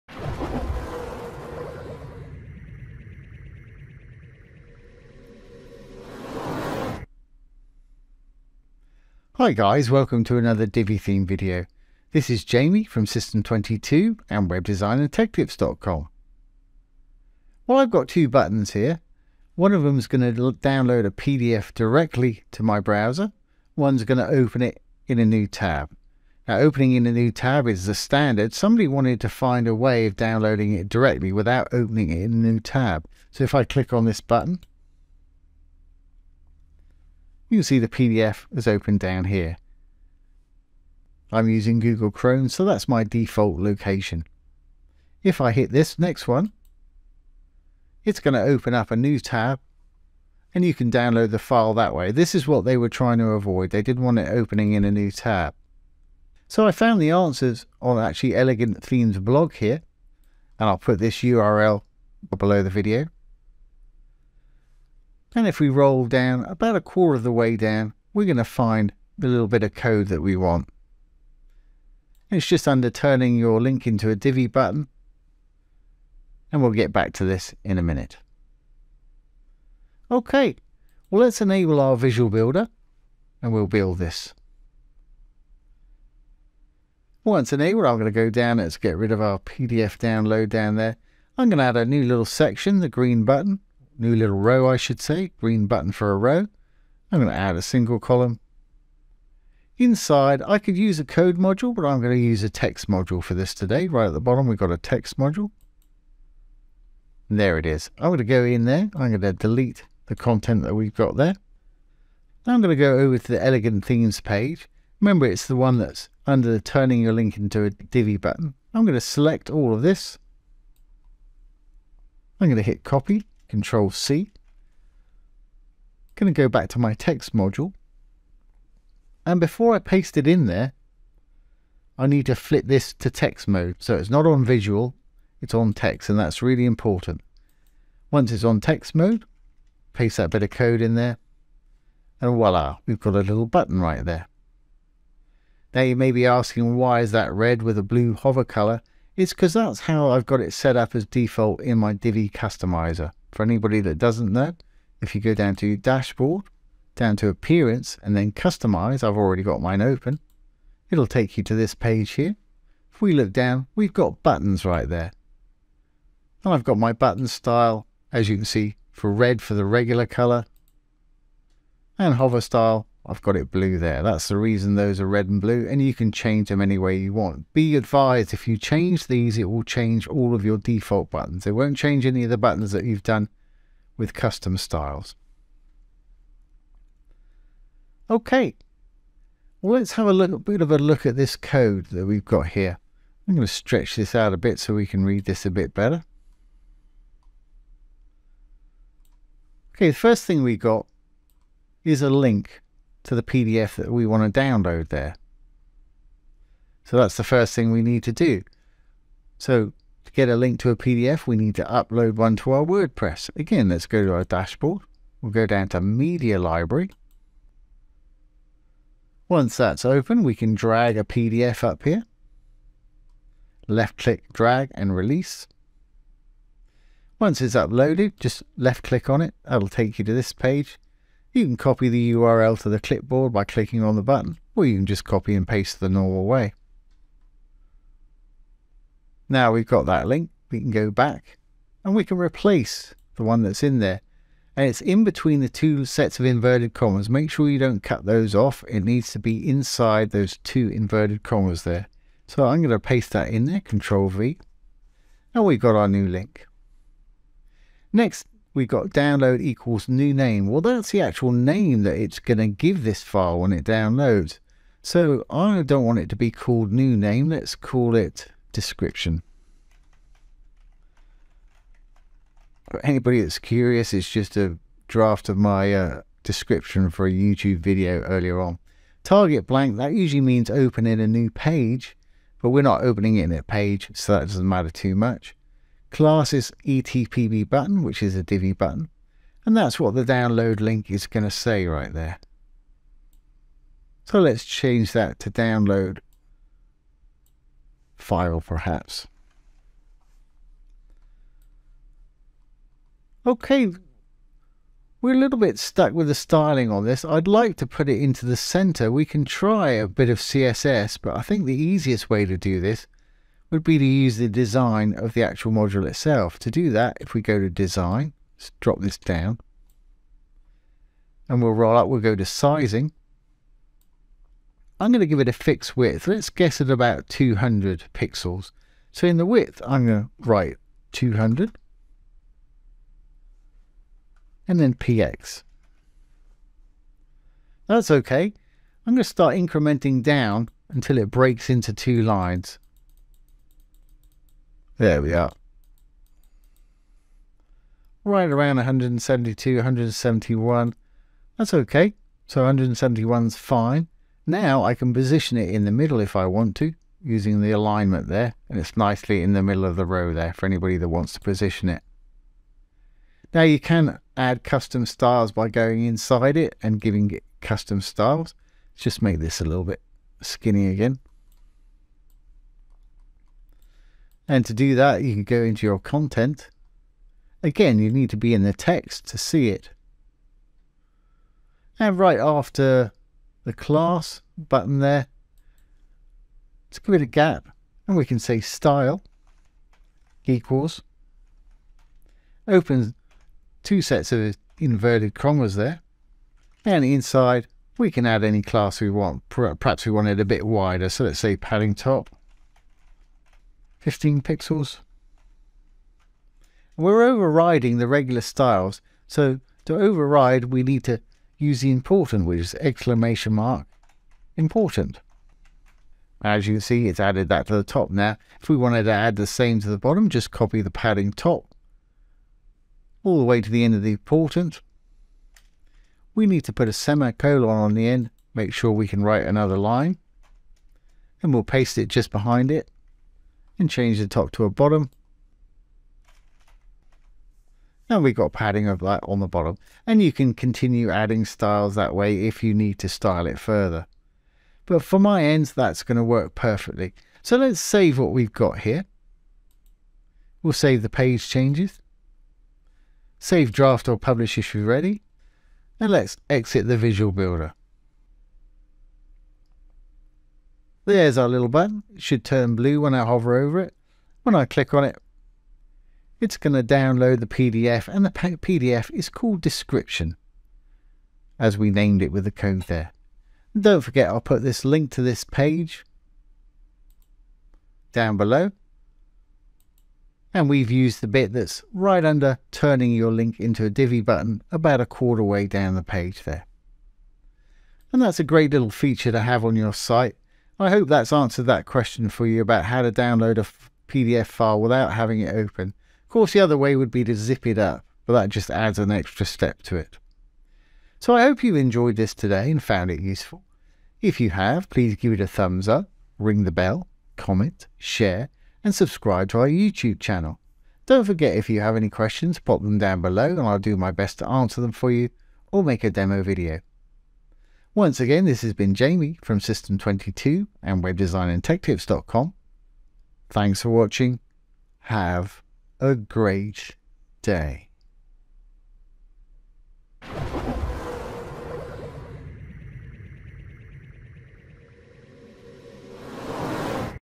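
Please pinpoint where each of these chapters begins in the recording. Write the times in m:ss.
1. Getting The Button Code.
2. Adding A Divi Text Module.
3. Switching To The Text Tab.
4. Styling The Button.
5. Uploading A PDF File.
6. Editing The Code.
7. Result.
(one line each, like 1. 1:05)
1. 1:12
2. 1:35
3. 2:09
4. 2:39
5. 3:41
6. 4:05
7. 8:15.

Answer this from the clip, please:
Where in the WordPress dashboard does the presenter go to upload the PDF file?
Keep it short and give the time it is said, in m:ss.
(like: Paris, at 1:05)
Media Library, at 3:35.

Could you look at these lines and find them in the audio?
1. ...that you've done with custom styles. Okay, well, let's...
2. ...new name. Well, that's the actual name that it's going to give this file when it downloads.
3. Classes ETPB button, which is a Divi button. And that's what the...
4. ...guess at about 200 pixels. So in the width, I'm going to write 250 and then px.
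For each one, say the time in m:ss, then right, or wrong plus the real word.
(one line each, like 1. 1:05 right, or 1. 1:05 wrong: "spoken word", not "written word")
1. 3:02 right
2. 4:19 right
3. 4:45 right
4. 5:26 wrong: "200", not "250".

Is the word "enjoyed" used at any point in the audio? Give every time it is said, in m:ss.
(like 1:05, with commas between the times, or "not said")
8:21.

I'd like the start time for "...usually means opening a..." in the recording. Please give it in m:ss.
4:39.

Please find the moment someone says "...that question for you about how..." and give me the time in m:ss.
8:11.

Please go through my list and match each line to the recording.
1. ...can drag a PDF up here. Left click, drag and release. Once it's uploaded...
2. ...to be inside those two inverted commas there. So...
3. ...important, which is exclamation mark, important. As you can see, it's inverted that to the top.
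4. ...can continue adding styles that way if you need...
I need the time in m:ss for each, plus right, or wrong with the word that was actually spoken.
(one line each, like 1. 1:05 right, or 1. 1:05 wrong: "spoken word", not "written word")
1. 3:40 right
2. 4:09 right
3. 6:51 wrong: "added", not "inverted"
4. 7:20 right.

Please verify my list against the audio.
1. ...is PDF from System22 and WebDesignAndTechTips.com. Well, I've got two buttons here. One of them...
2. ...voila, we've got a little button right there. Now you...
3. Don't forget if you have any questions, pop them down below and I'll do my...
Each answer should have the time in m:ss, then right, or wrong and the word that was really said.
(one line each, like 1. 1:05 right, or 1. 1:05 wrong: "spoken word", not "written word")
1. 0:12 wrong: "Jamie", not "PDF"
2. 2:22 right
3. 8:30 right.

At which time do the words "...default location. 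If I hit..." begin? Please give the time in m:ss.
0:43.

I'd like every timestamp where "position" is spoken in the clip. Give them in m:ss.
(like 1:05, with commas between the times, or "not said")
5:54, 6:01.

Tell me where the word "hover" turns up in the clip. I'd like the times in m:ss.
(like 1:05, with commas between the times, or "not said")
2:28, 2:52, 7:43.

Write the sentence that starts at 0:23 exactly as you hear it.
One's going to open it in a new tab.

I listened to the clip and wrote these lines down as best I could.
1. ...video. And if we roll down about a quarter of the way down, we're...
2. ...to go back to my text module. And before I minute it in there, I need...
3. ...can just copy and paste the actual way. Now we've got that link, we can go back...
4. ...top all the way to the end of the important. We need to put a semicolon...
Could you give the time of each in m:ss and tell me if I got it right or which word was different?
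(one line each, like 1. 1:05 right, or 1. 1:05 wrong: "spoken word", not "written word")
1. 1:02 right
2. 2:06 wrong: "paste", not "minute"
3. 3:54 wrong: "normal", not "actual"
4. 7:01 right.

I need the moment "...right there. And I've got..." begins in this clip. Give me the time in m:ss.
2:44.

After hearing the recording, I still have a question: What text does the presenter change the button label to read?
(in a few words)
download file.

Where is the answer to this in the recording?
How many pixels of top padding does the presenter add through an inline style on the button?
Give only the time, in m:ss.
6:43.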